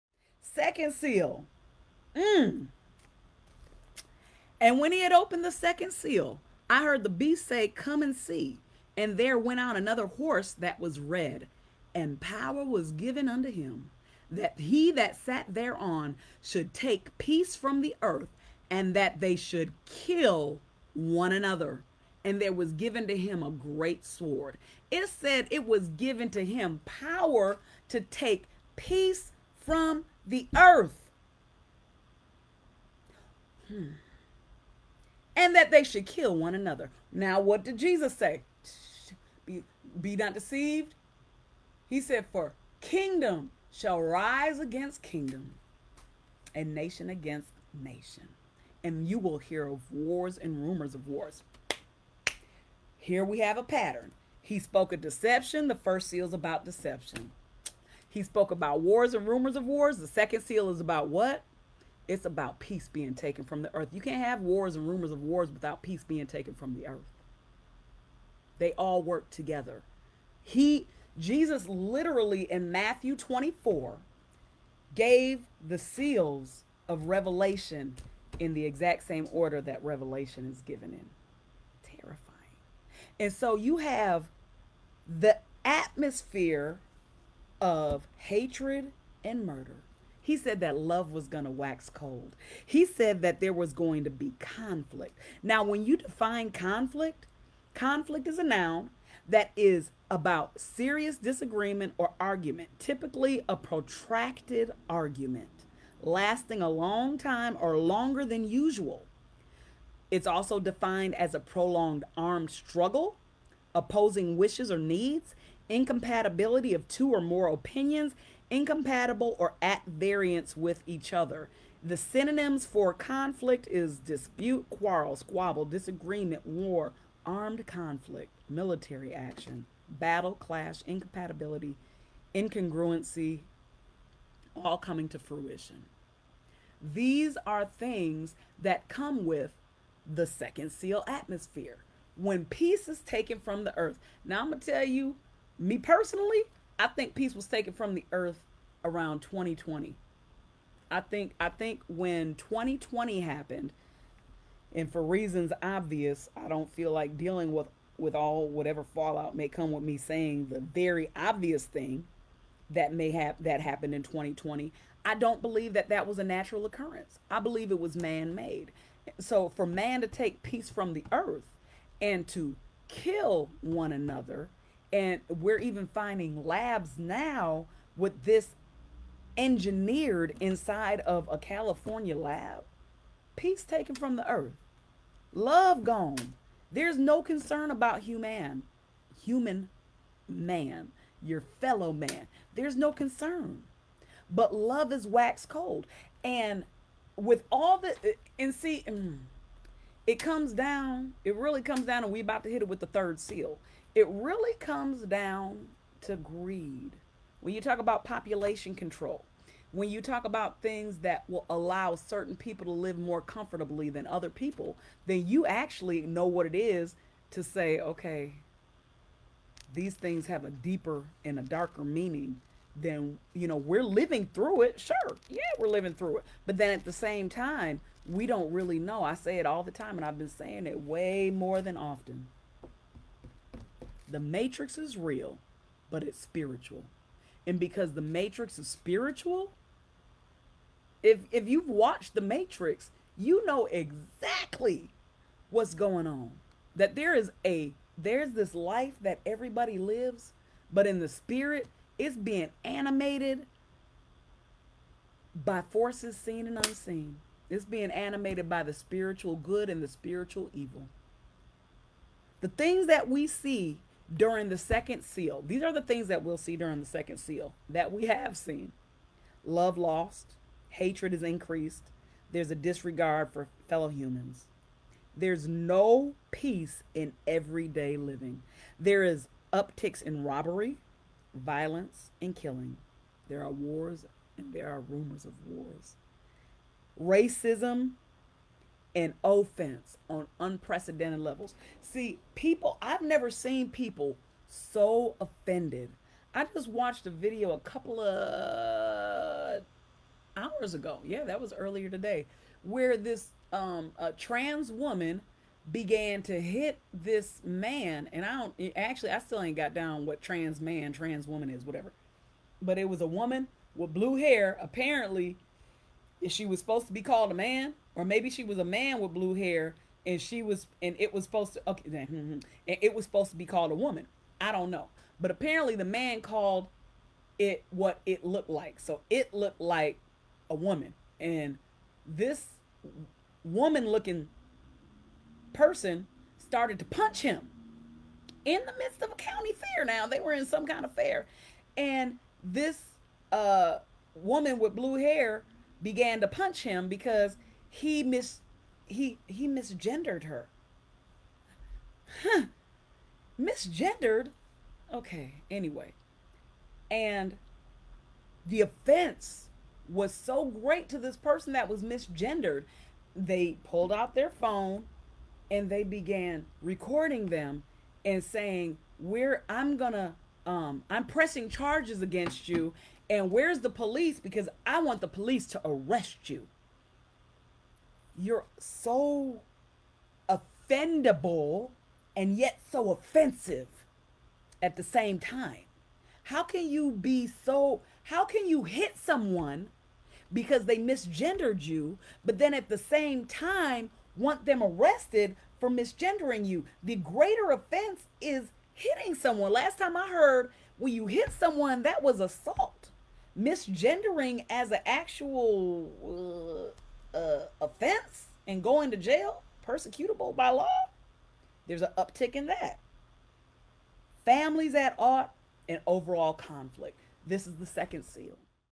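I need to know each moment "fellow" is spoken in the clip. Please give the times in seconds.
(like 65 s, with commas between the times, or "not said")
191 s, 273 s.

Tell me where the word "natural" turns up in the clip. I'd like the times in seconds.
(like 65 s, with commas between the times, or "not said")
166 s.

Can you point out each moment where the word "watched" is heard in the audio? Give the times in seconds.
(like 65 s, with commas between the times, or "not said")
241 s, 296 s.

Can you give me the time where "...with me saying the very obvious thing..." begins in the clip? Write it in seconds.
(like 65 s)
159 s.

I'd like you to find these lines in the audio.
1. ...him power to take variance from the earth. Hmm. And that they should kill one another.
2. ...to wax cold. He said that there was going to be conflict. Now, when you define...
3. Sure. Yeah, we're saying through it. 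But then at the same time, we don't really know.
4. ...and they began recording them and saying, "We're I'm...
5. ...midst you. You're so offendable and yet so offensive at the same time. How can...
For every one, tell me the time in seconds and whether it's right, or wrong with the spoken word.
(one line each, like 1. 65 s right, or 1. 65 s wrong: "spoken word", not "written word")
1. 26 s wrong: "peace", not "variance"
2. 91 s right
3. 224 s wrong: "living", not "saying"
4. 365 s right
5. 375 s wrong: "arrest", not "midst".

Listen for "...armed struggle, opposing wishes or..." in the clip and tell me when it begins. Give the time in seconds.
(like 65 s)
112 s.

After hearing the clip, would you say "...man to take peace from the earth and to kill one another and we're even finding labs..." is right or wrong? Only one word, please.
right.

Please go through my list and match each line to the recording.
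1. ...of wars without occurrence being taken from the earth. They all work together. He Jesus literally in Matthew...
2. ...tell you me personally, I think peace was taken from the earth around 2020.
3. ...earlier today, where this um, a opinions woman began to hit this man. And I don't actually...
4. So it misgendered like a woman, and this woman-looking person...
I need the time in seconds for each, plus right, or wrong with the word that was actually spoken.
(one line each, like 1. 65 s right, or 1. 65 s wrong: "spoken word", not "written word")
1. 65 s wrong: "peace", not "occurrence"
2. 144 s right
3. 301 s wrong: "trans", not "opinions"
4. 328 s wrong: "looked", not "misgendered".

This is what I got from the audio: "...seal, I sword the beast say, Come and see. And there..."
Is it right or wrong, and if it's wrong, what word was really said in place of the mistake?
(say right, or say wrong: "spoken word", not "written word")
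wrong: "heard", not "sword".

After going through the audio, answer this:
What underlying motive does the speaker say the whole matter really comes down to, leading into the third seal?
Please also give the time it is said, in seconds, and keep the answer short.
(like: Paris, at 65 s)
Greed, at 206 s.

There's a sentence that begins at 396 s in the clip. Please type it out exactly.
The greater offense is hitting someone.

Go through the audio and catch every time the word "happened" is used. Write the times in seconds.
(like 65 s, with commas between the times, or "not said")
153 s, 163 s.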